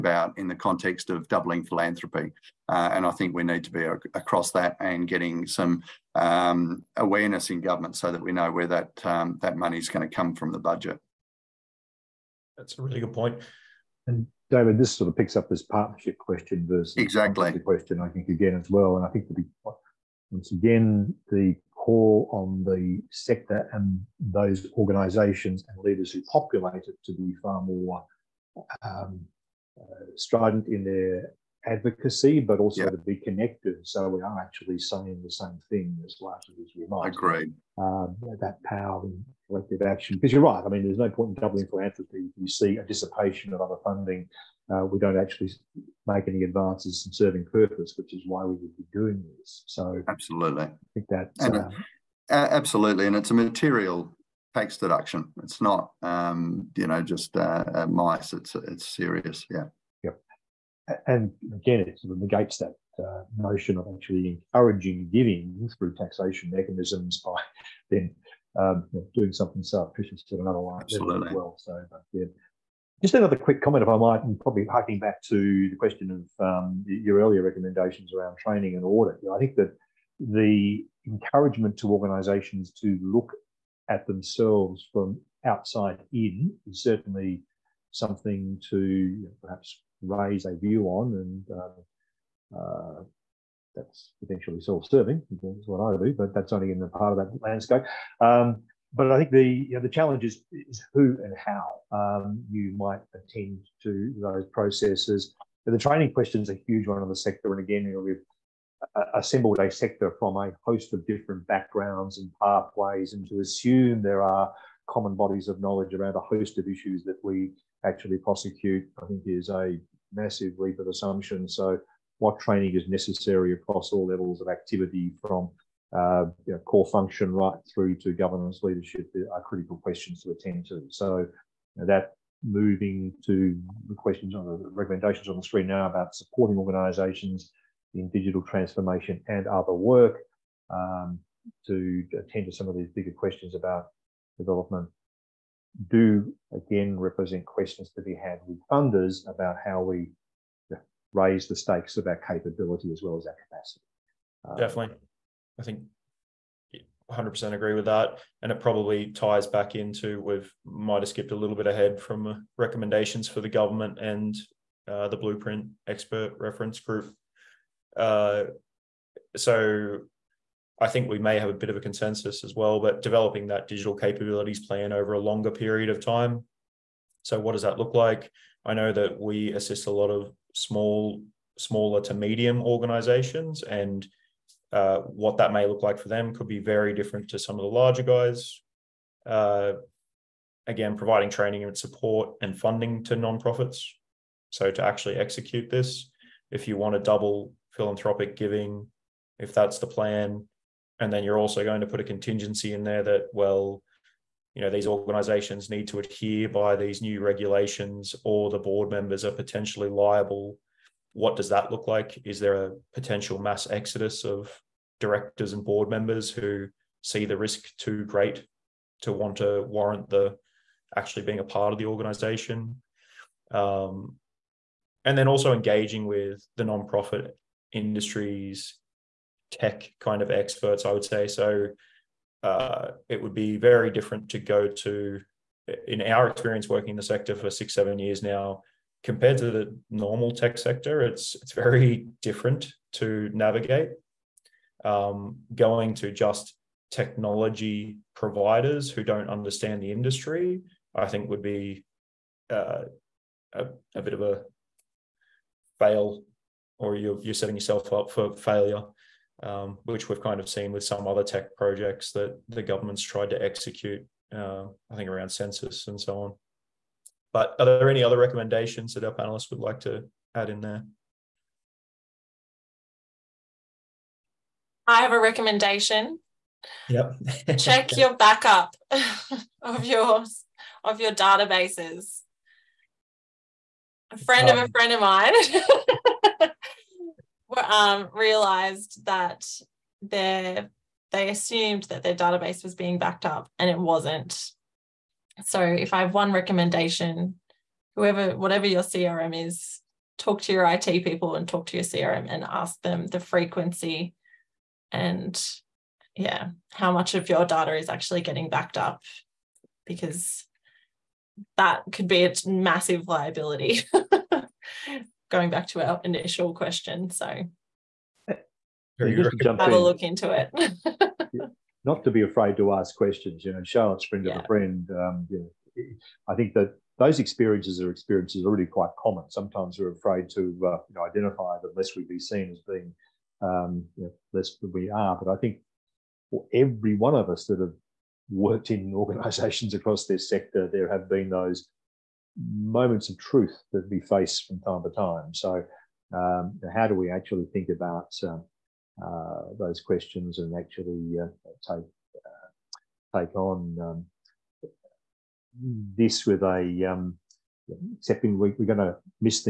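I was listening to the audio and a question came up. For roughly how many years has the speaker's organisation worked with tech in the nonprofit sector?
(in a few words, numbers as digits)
6 or 7 years.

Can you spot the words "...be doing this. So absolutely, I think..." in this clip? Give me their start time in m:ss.
0:48.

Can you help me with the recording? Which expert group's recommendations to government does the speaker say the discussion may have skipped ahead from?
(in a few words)
Blueprint Expert Reference Group.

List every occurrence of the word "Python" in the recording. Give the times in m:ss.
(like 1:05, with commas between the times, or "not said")
not said.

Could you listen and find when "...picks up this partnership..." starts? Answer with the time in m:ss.
0:15.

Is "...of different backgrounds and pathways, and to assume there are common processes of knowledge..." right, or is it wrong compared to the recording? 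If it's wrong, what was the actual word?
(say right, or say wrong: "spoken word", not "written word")
wrong: "bodies", not "processes".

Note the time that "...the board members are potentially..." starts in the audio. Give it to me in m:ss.
3:28.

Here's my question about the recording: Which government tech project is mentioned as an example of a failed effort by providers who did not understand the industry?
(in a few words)
Census.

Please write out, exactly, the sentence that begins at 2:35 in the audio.
I think 100% agree with that.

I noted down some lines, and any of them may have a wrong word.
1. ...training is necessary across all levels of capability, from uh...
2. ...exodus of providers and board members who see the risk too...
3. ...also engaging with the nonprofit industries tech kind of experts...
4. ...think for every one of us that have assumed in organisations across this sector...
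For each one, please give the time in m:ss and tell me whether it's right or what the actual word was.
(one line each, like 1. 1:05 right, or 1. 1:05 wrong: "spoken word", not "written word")
1. 2:02 wrong: "activity", not "capability"
2. 3:33 wrong: "directors", not "providers"
3. 3:45 right
4. 5:35 wrong: "worked", not "assumed".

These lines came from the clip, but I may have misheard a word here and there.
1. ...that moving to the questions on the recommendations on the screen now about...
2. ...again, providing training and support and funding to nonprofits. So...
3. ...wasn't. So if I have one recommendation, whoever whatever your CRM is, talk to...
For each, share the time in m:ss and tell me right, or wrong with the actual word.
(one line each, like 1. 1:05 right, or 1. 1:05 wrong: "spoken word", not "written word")
1. 2:11 right
2. 3:10 right
3. 4:53 right.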